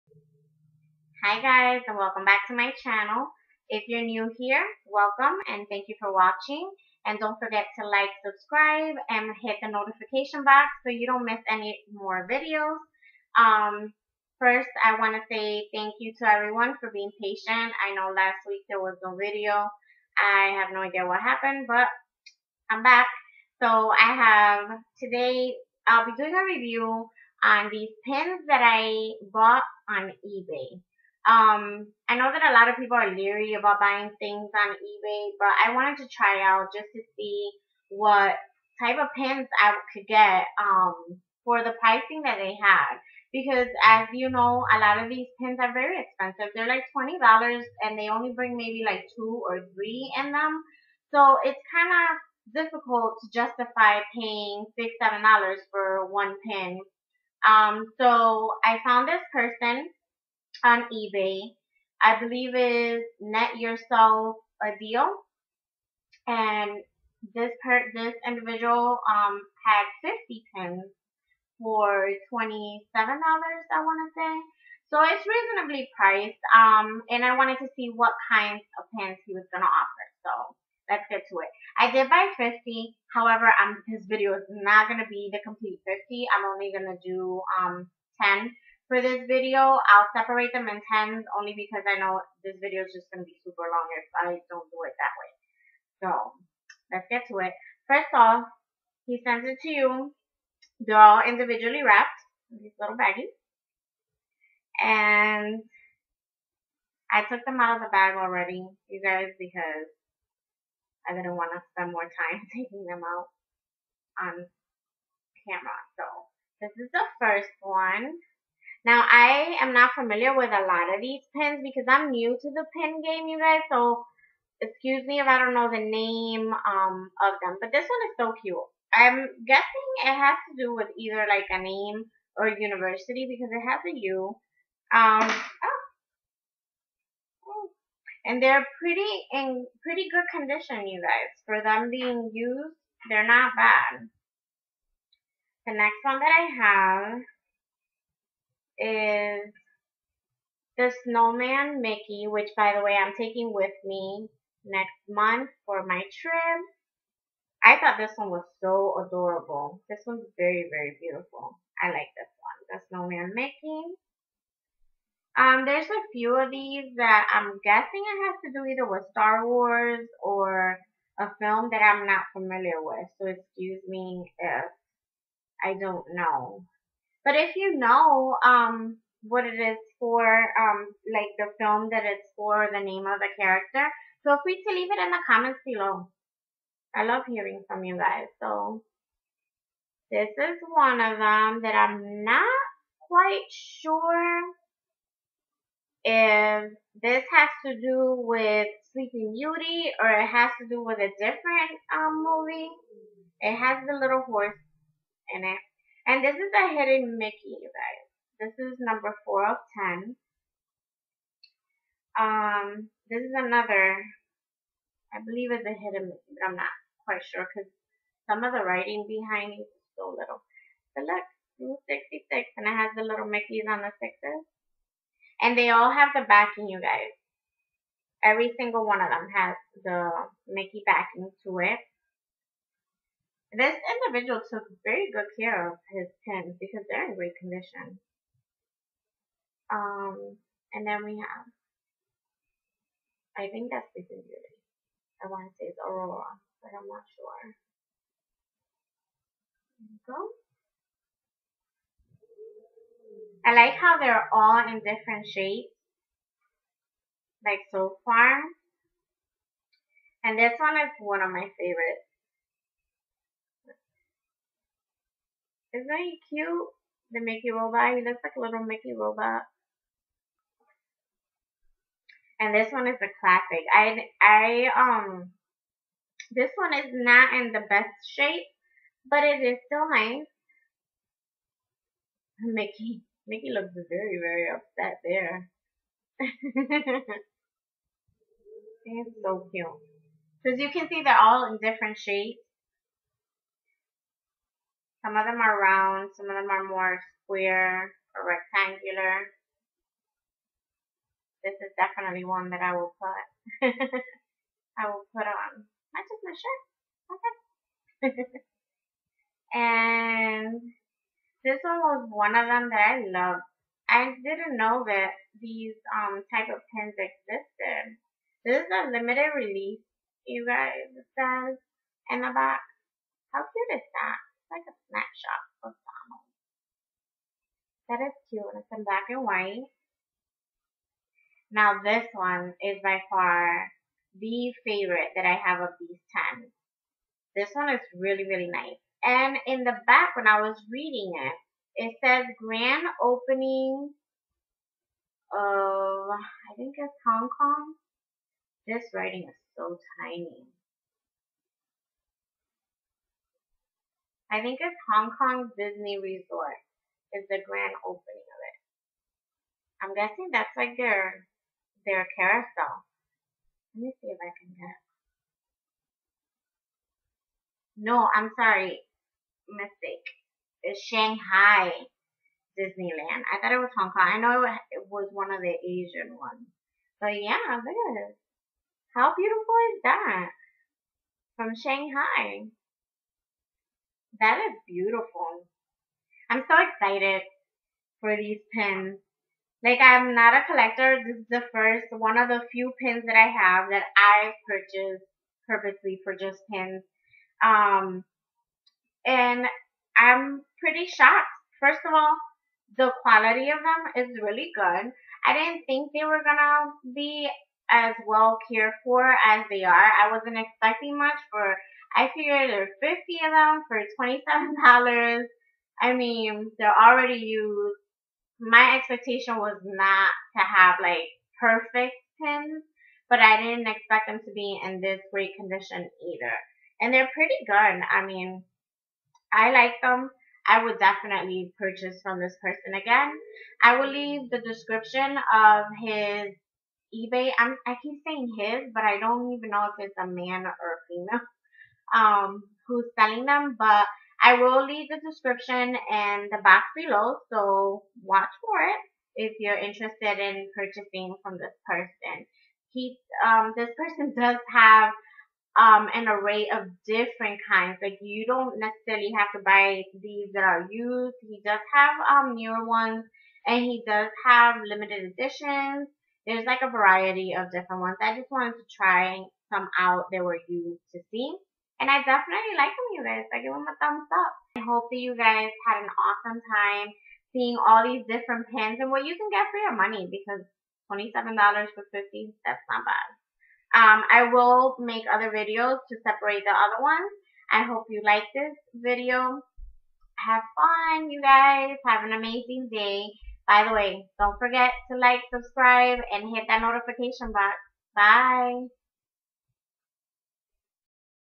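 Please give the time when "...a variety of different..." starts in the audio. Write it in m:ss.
7:46.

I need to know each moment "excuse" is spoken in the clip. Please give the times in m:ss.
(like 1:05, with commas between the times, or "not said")
2:04, 2:53.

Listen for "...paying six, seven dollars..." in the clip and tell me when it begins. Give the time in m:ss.
0:54.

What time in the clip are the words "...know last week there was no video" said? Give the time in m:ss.
0:17.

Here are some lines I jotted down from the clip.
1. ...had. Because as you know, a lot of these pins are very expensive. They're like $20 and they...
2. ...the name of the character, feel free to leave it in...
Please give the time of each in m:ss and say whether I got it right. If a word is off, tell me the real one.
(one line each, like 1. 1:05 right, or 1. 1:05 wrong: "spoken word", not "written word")
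1. 0:42 right
2. 3:02 right.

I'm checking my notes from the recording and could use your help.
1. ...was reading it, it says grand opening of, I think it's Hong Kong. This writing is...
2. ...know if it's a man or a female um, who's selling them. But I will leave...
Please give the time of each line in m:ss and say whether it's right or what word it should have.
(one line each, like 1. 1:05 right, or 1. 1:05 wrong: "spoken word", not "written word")
1. 5:40 right
2. 7:19 right.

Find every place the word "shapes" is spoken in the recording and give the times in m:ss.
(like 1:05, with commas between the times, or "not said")
4:15, 4:38, 4:51.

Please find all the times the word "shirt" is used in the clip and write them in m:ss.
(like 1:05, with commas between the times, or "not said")
5:08.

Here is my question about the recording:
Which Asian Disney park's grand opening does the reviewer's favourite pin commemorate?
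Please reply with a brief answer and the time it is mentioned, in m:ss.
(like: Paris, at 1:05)
Shanghai Disneyland, at 6:10.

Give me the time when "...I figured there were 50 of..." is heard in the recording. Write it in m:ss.
6:51.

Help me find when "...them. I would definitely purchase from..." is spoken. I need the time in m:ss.
7:09.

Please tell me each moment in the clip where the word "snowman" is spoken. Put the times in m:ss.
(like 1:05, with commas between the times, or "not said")
2:31, 2:42.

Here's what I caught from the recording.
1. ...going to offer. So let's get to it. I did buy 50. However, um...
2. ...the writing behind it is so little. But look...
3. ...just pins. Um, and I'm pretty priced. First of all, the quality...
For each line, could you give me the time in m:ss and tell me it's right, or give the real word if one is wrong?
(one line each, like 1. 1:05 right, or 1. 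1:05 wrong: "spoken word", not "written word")
1. 1:19 right
2. 3:38 right
3. 6:36 wrong: "shocked", not "priced".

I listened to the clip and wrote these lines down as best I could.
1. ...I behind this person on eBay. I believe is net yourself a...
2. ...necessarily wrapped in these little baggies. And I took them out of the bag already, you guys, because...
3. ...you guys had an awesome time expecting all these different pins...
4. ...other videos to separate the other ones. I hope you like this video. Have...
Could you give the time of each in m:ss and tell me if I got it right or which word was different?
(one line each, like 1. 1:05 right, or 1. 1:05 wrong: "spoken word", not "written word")
1. 0:58 wrong: "found", not "behind"
2. 1:41 wrong: "individually", not "necessarily"
3. 7:55 wrong: "seeing", not "expecting"
4. 8:05 right.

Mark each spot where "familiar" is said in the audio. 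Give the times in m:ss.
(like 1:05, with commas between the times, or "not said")
1:59, 2:52.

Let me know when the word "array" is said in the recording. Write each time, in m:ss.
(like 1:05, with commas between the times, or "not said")
7:36.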